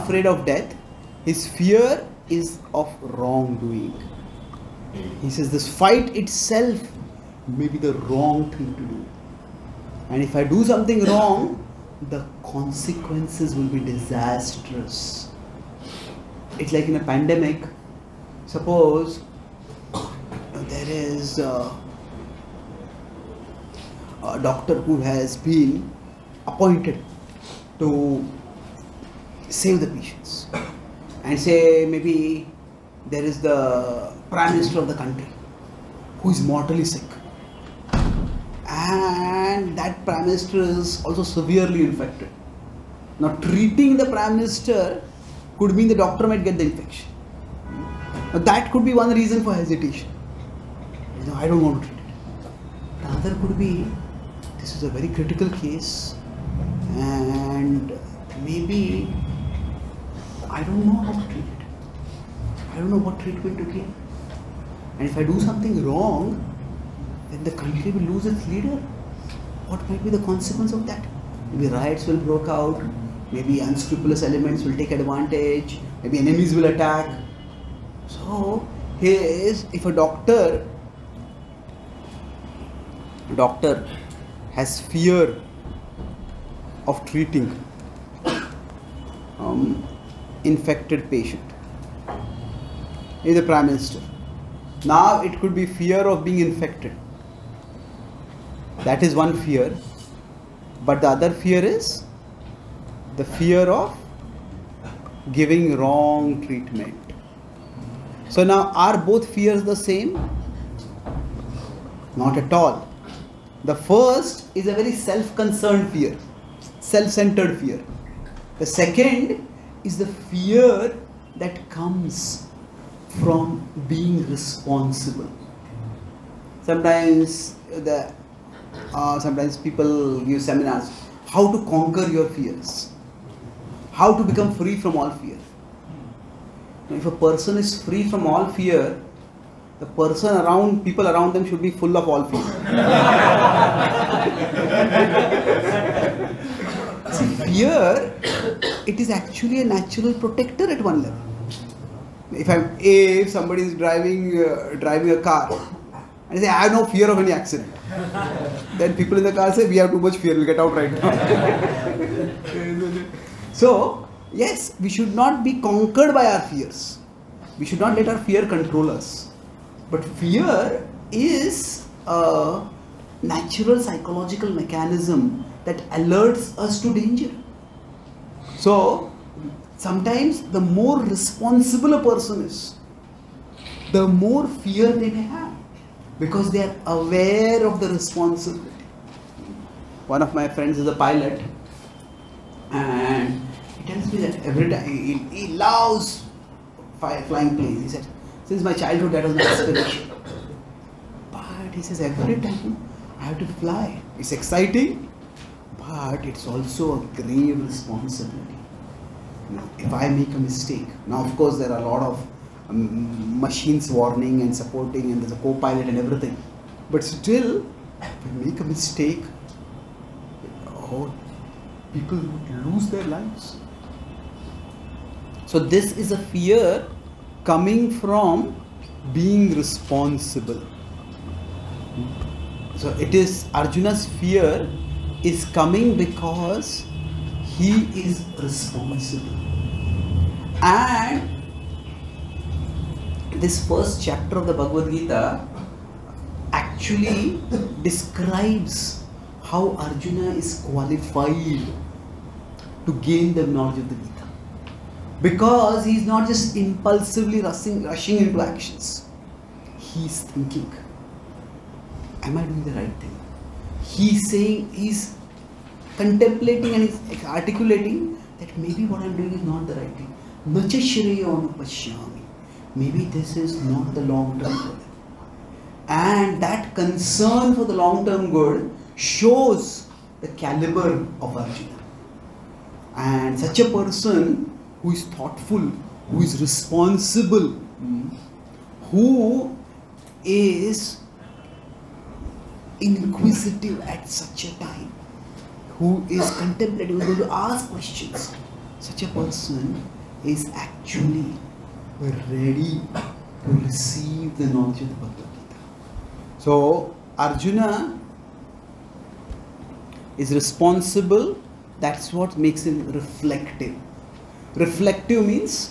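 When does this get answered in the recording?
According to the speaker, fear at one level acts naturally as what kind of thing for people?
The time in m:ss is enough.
2:29.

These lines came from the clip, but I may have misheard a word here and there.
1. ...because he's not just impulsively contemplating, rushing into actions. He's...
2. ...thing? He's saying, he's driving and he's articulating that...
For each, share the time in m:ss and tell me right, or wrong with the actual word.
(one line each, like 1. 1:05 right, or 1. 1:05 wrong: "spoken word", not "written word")
1. 4:15 wrong: "rushing", not "contemplating"
2. 4:23 wrong: "contemplating", not "driving".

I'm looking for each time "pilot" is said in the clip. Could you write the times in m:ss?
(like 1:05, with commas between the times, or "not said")
3:10, 3:35.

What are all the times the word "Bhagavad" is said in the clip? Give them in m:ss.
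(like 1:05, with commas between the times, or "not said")
4:04, 5:04.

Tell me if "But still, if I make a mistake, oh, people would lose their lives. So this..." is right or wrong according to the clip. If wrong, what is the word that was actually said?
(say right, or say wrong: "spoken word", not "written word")
right.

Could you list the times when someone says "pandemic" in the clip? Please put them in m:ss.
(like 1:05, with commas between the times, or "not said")
0:17.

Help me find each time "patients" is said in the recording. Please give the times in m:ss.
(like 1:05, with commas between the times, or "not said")
0:29, 1:31.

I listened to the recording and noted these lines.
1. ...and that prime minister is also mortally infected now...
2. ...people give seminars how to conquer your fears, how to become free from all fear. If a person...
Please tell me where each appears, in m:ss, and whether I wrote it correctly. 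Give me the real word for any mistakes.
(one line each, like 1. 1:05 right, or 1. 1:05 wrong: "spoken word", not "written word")
1. 0:38 wrong: "severely", not "mortally"
2. 2:09 right.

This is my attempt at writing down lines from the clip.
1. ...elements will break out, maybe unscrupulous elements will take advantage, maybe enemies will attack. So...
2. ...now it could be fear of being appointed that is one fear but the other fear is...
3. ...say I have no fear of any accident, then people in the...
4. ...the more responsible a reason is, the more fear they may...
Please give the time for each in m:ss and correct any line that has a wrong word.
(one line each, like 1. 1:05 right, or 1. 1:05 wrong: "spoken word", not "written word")
1. 1:11 wrong: "riots", not "elements"
2. 1:34 wrong: "infected", not "appointed"
3. 2:36 right
4. 3:00 wrong: "person", not "reason".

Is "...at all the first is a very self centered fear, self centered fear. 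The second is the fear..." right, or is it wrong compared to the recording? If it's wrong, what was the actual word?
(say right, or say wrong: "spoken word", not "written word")
wrong: "concerned", not "centered".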